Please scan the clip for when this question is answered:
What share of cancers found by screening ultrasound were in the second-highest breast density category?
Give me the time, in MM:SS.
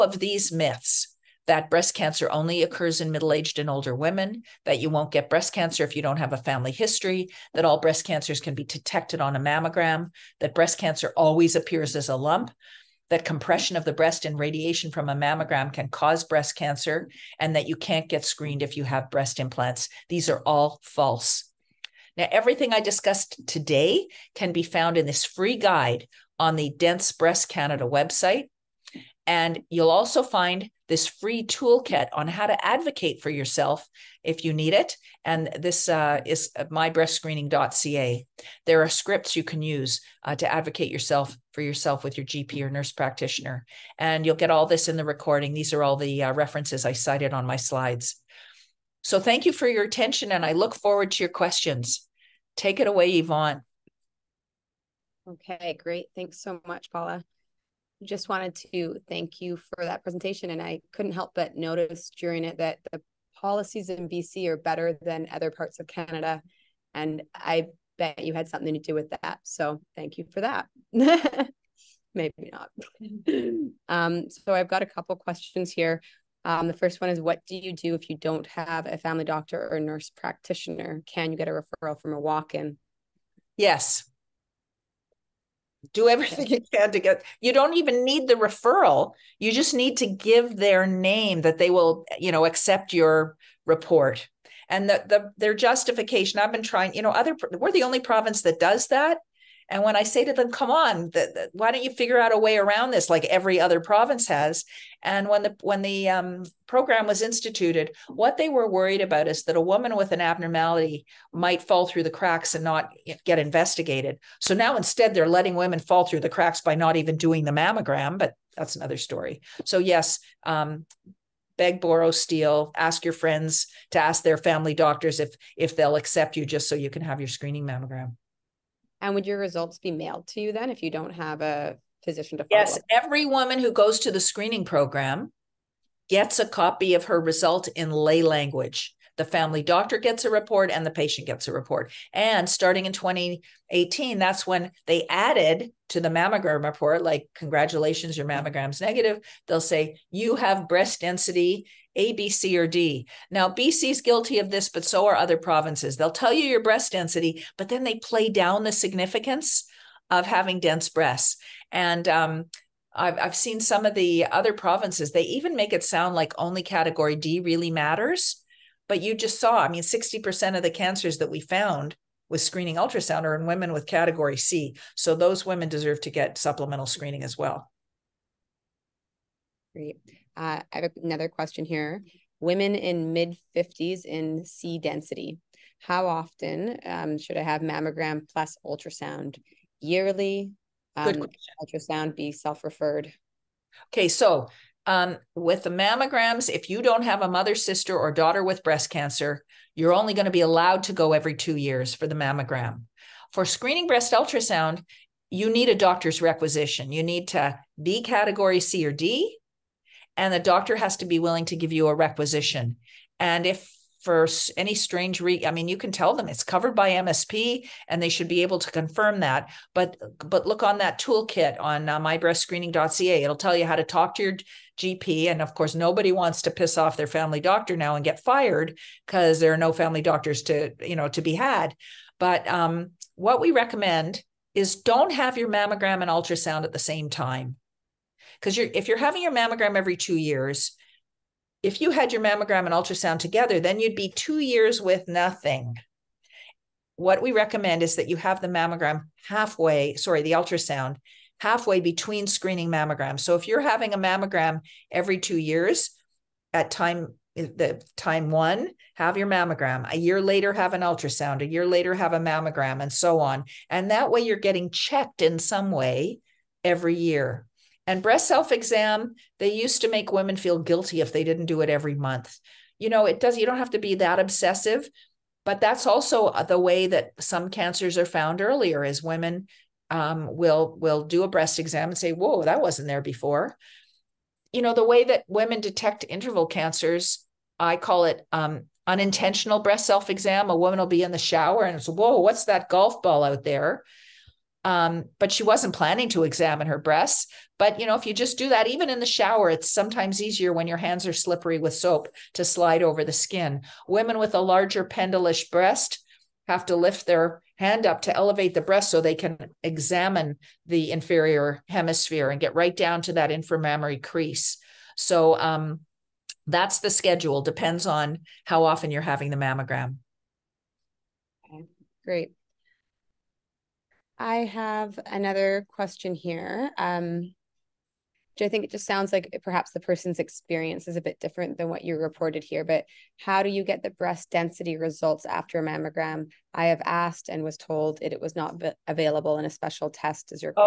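02:49.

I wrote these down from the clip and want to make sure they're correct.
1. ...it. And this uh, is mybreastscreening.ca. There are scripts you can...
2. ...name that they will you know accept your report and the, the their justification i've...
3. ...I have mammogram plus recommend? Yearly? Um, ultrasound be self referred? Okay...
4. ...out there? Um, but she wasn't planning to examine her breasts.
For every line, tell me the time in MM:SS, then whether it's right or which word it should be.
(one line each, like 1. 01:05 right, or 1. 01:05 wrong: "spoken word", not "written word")
1. 00:34 right
2. 01:30 right
3. 03:07 wrong: "ultrasound", not "recommend"
4. 04:53 right.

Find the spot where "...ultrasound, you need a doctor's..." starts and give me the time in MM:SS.
03:24.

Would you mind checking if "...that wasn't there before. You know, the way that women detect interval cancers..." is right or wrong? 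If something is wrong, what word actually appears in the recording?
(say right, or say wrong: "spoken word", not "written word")
right.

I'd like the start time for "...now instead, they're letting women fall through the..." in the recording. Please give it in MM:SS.
01:54.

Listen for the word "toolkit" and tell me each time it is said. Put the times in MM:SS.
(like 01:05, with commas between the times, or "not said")
00:31, 03:41.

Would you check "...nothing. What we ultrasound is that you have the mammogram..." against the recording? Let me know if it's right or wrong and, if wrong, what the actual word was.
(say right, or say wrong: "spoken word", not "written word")
wrong: "recommend", not "ultrasound".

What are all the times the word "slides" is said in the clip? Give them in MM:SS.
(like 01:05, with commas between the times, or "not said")
00:47, 05:02.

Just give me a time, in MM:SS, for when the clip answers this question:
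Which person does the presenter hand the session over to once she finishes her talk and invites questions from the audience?
00:53.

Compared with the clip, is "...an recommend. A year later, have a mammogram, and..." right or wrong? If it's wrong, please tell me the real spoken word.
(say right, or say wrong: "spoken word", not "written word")
wrong: "ultrasound", not "recommend".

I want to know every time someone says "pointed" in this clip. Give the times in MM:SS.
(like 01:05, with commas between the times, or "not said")
not said.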